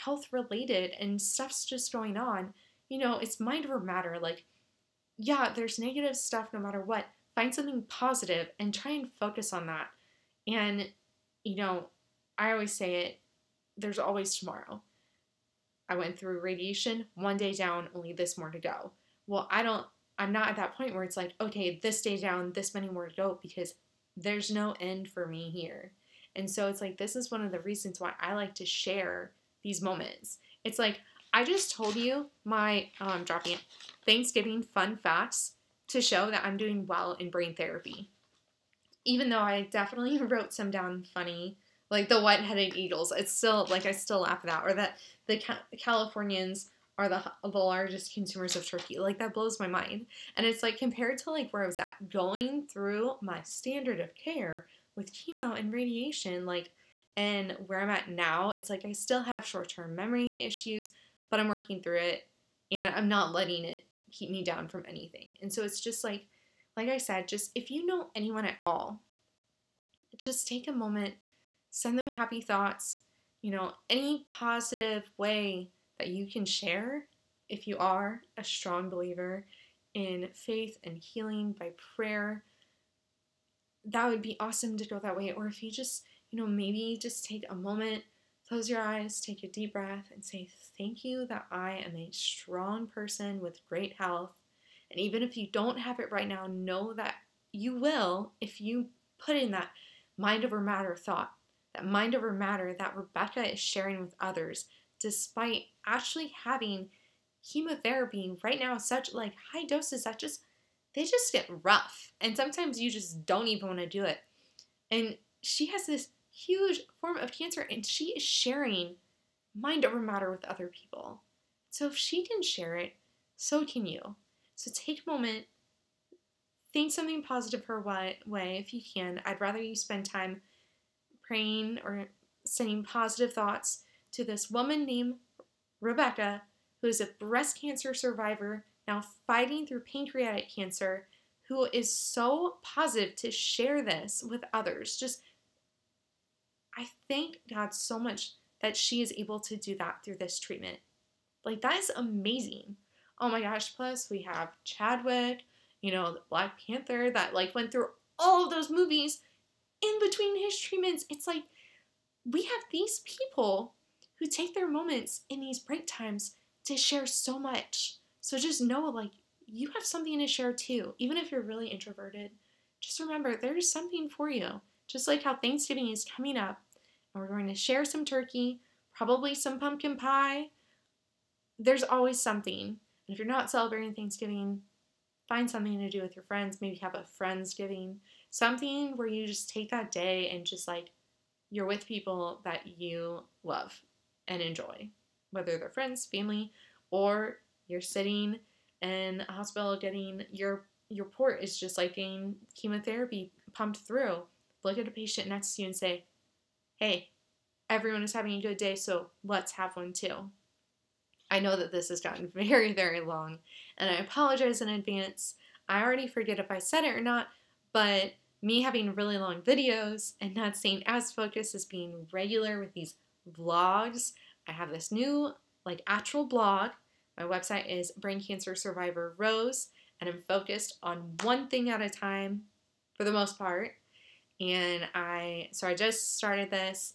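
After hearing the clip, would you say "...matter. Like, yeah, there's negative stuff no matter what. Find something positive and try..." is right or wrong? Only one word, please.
right.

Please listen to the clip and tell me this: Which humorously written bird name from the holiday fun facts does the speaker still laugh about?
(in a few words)
white headed eagles.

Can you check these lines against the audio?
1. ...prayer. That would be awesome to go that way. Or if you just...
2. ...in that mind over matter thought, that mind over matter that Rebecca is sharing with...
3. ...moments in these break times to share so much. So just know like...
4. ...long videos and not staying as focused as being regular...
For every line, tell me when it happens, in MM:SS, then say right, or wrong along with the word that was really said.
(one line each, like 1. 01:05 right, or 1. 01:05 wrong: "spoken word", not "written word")
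1. 01:21 right
2. 01:39 right
3. 02:44 right
4. 03:39 right.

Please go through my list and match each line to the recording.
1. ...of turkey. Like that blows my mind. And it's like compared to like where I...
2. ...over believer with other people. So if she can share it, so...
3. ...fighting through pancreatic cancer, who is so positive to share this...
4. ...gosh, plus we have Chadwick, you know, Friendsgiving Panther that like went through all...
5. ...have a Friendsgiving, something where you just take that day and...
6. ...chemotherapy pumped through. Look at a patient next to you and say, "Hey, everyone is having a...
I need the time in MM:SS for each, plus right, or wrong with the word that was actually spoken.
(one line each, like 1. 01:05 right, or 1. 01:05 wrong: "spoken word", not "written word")
1. 00:48 right
2. 01:59 wrong: "matter", not "believer"
3. 02:19 right
4. 02:33 wrong: "Black", not "Friendsgiving"
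5. 03:06 right
6. 03:22 right.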